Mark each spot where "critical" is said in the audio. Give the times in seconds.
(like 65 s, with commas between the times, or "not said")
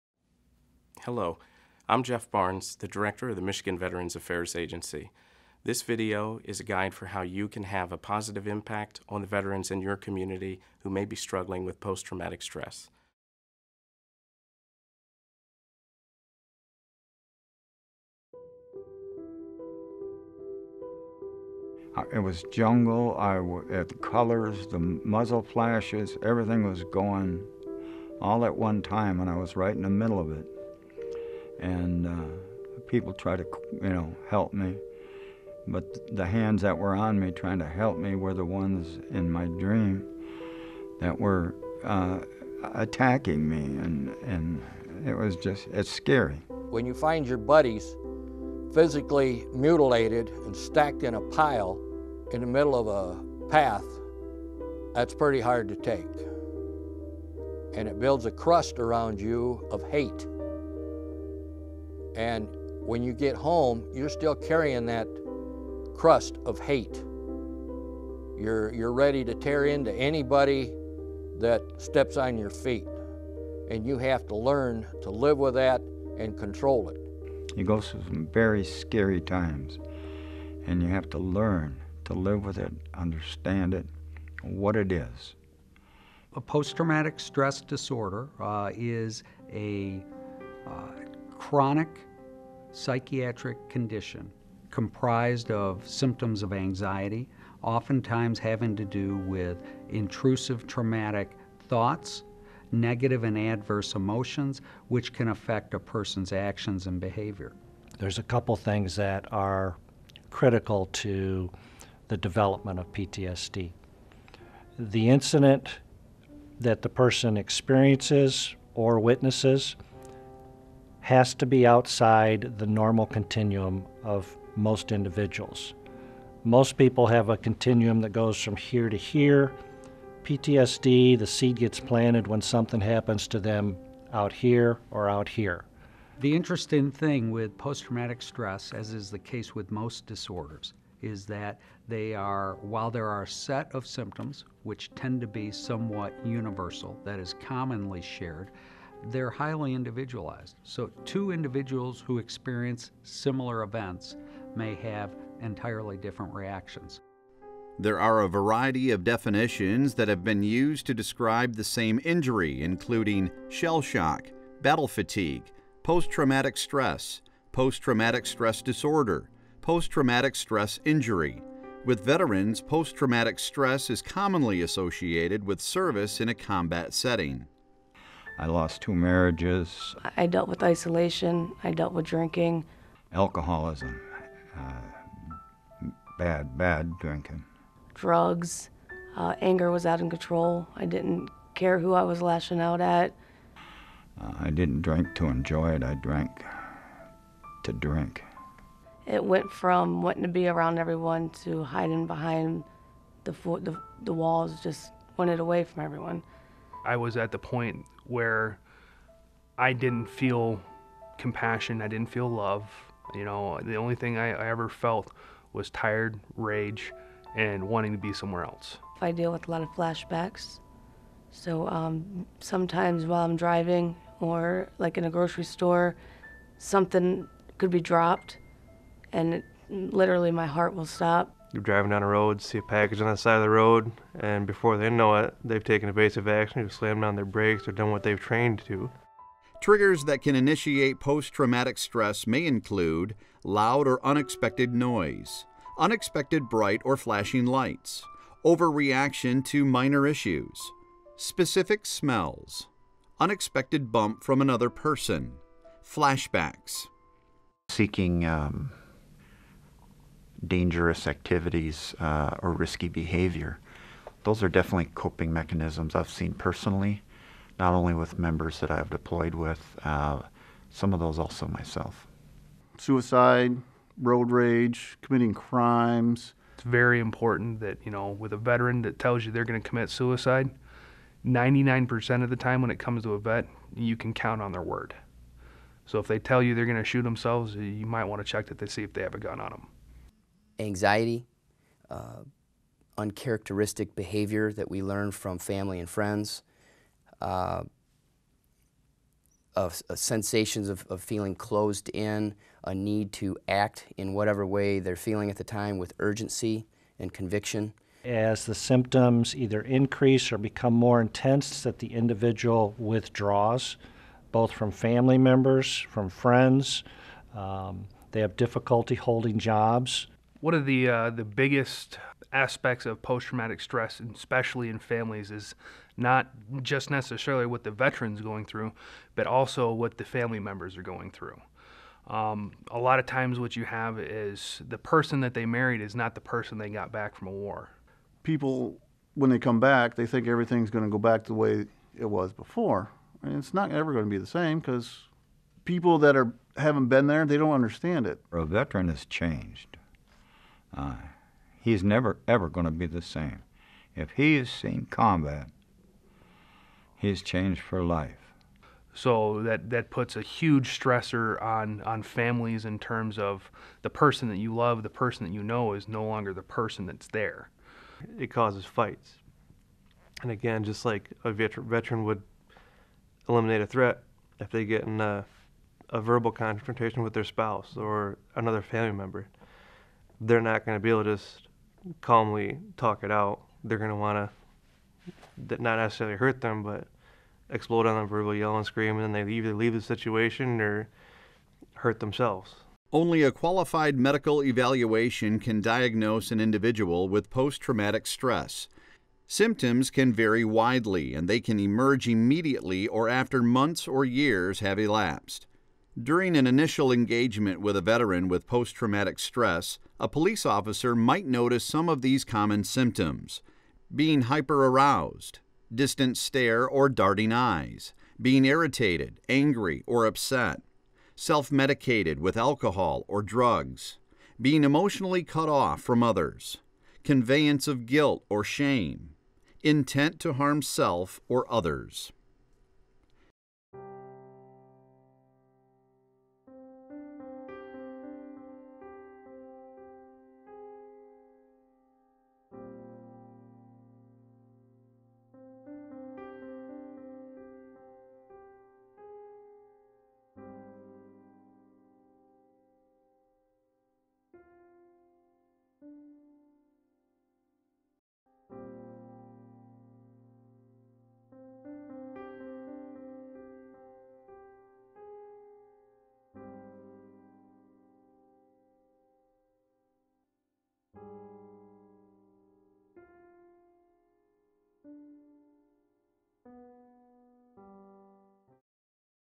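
110 s.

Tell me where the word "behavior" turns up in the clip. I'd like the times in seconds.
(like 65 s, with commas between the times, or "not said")
107 s, 262 s, 293 s.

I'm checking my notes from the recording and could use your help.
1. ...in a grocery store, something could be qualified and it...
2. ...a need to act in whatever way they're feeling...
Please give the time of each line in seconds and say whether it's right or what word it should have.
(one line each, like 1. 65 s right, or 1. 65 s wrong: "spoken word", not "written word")
1. 224 s wrong: "dropped", not "qualified"
2. 302 s right.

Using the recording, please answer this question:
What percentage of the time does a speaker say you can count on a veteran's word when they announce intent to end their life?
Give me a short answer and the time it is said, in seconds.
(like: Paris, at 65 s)
99%, at 281 s.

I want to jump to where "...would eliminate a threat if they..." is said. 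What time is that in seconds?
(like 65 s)
372 s.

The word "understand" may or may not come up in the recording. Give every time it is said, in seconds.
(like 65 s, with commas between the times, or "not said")
82 s, 347 s.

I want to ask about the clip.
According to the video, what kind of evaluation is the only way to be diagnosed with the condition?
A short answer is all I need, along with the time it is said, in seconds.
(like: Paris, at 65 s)
A qualified medical evaluation, at 393 s.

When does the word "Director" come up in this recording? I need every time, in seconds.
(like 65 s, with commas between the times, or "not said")
2 s.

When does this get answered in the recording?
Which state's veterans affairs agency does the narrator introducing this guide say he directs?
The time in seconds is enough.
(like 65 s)
3 s.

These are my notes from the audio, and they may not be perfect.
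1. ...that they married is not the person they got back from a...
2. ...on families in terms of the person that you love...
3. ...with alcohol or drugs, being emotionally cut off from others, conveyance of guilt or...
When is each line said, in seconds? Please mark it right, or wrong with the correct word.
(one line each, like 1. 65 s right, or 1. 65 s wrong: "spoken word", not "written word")
1. 335 s right
2. 361 s right
3. 422 s right.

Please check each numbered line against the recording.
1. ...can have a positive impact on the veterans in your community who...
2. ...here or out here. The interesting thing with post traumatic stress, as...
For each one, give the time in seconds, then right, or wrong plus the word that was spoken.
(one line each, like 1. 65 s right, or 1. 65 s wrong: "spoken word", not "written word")
1. 7 s right
2. 134 s right.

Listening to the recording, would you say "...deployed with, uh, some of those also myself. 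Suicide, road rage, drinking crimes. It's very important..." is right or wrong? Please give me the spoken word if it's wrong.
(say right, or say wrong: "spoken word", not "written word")
wrong: "committing", not "drinking".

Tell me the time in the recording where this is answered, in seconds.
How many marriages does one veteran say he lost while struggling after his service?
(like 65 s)
178 s.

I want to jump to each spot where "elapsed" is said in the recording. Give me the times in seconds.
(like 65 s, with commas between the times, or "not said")
404 s.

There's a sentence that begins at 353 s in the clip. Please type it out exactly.
If he has seen combat, he's changed for life.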